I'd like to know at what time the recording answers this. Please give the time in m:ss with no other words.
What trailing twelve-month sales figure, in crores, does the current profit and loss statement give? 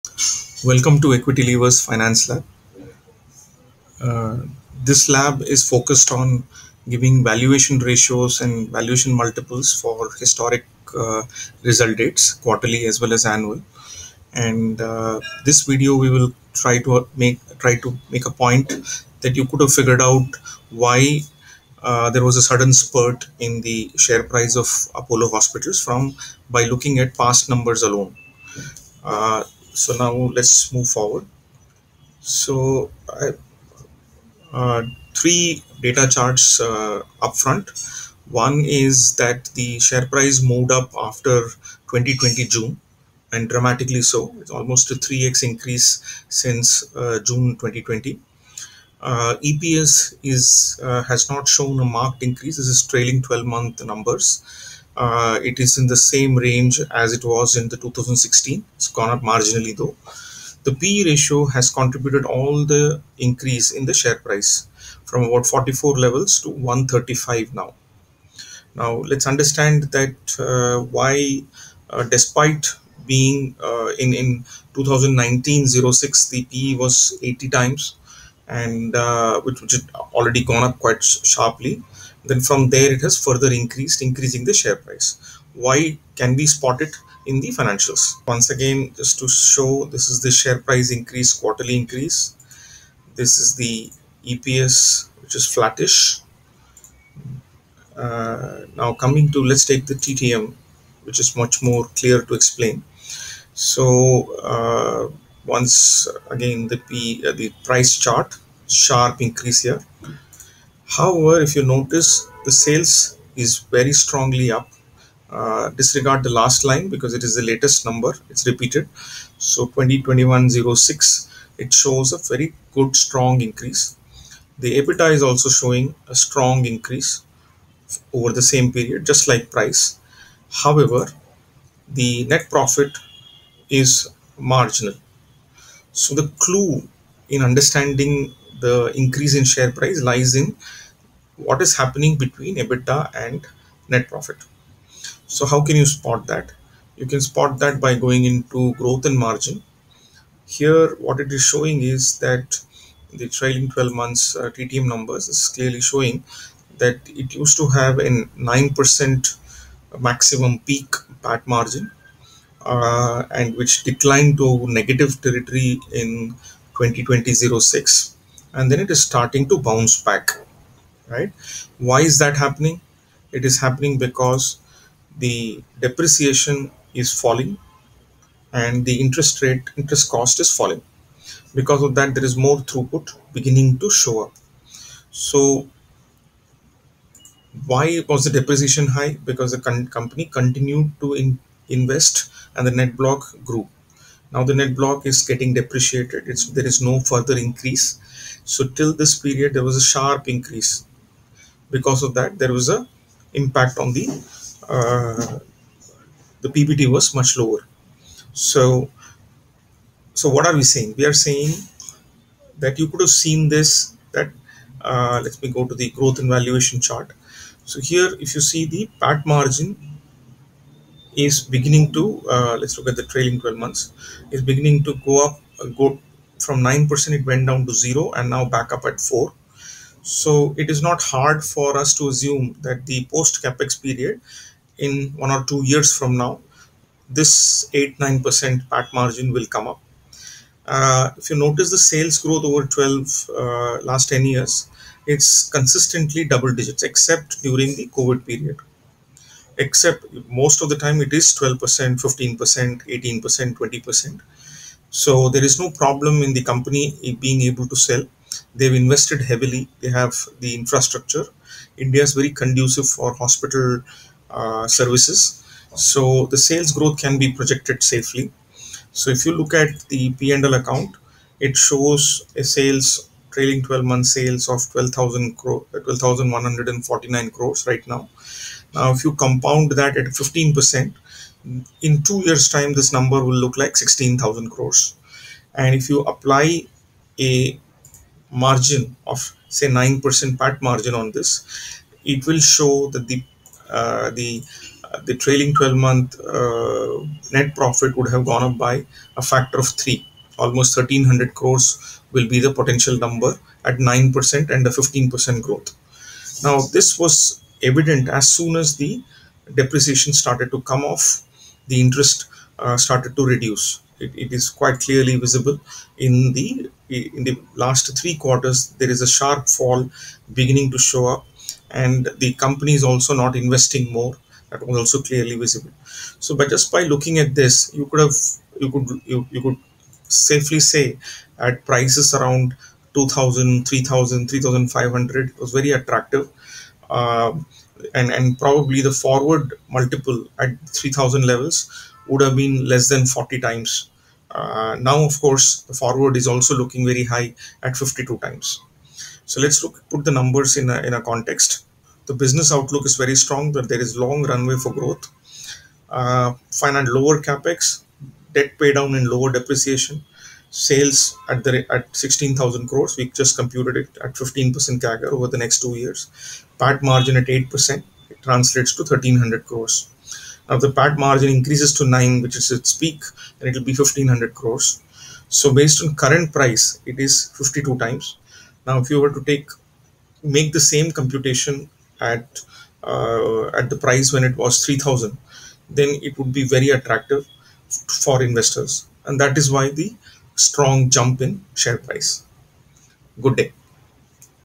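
4:34.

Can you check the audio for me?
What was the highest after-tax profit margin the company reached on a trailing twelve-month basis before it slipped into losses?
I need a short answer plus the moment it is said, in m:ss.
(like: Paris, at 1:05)
9%, at 2:38.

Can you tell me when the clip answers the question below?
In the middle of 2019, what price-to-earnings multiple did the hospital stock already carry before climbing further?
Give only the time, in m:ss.
1:17.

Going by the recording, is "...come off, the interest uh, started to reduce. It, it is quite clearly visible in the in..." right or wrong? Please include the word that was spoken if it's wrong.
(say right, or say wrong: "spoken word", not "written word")
right.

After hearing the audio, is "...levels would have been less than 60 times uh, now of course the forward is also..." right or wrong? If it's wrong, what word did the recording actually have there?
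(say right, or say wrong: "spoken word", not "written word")
wrong: "40", not "60".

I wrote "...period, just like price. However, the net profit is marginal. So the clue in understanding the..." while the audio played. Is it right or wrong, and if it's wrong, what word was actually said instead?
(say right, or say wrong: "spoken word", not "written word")
right.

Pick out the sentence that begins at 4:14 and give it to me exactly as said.
So there is no problem in the company being able to sell.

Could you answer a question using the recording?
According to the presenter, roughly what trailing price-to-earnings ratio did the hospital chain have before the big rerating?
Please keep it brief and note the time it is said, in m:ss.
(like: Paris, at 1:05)
44, at 1:05.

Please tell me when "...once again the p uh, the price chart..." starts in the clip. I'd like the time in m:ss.
1:45.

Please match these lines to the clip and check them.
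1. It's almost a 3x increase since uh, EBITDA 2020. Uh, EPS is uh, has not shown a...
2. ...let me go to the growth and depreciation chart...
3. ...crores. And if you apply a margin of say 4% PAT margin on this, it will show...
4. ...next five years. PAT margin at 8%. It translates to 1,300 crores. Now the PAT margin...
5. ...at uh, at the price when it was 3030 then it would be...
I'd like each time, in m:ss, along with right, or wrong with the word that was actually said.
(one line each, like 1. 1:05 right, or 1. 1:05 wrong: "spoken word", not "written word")
1. 0:44 wrong: "June", not "EBITDA"
2. 3:35 wrong: "valuation", not "depreciation"
3. 4:44 wrong: "9", not "4"
4. 6:05 wrong: "two", not "five"
5. 6:22 wrong: "3000", not "3030".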